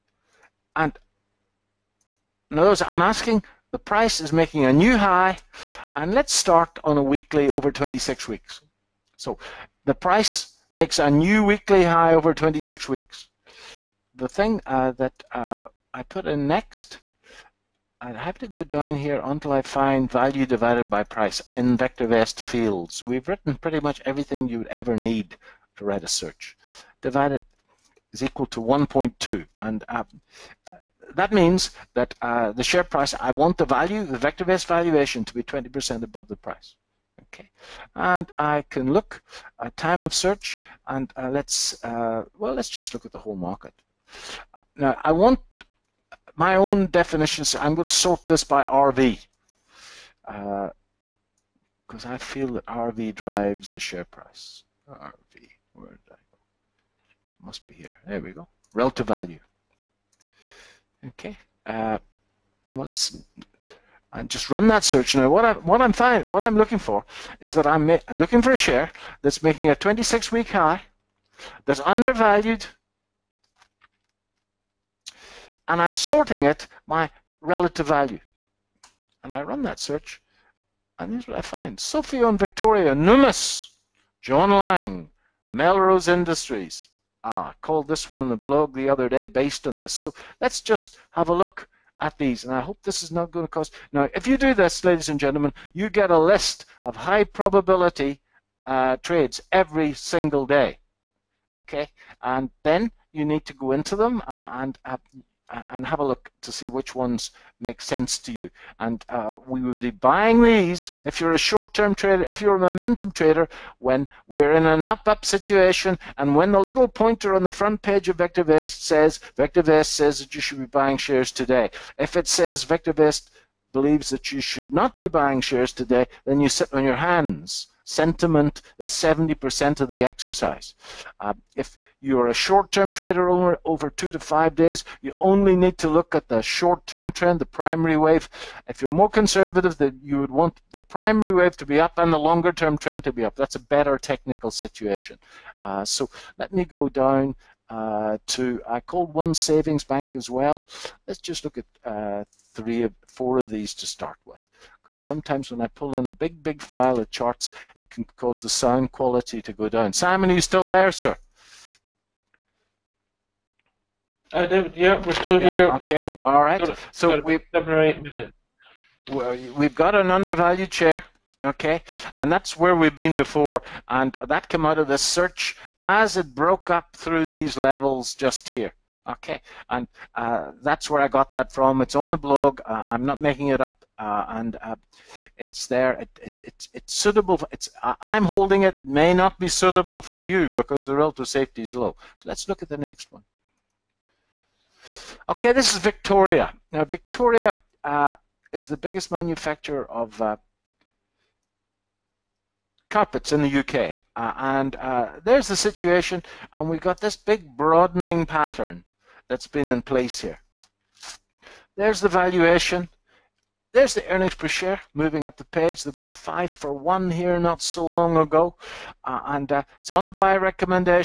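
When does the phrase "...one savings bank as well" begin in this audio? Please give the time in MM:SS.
02:29.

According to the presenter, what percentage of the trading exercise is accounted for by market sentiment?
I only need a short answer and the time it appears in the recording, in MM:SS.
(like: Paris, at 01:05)
70%, at 02:08.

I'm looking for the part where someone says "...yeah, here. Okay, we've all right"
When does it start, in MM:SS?
02:45.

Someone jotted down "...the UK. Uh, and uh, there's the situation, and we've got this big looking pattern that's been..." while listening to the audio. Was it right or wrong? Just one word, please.
wrong.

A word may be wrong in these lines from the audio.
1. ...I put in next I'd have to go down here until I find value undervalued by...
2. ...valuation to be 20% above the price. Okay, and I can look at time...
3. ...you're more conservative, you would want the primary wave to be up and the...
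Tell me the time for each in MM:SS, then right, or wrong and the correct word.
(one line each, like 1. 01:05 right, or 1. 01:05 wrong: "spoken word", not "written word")
1. 00:15 wrong: "divided", not "undervalued"
2. 00:34 right
3. 02:18 right.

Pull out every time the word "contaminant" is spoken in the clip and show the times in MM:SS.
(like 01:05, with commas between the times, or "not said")
not said.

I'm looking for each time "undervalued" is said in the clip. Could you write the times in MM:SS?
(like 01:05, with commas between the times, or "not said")
01:11, 02:50.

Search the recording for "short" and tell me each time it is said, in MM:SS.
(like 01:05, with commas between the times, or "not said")
01:51, 02:12, 02:16.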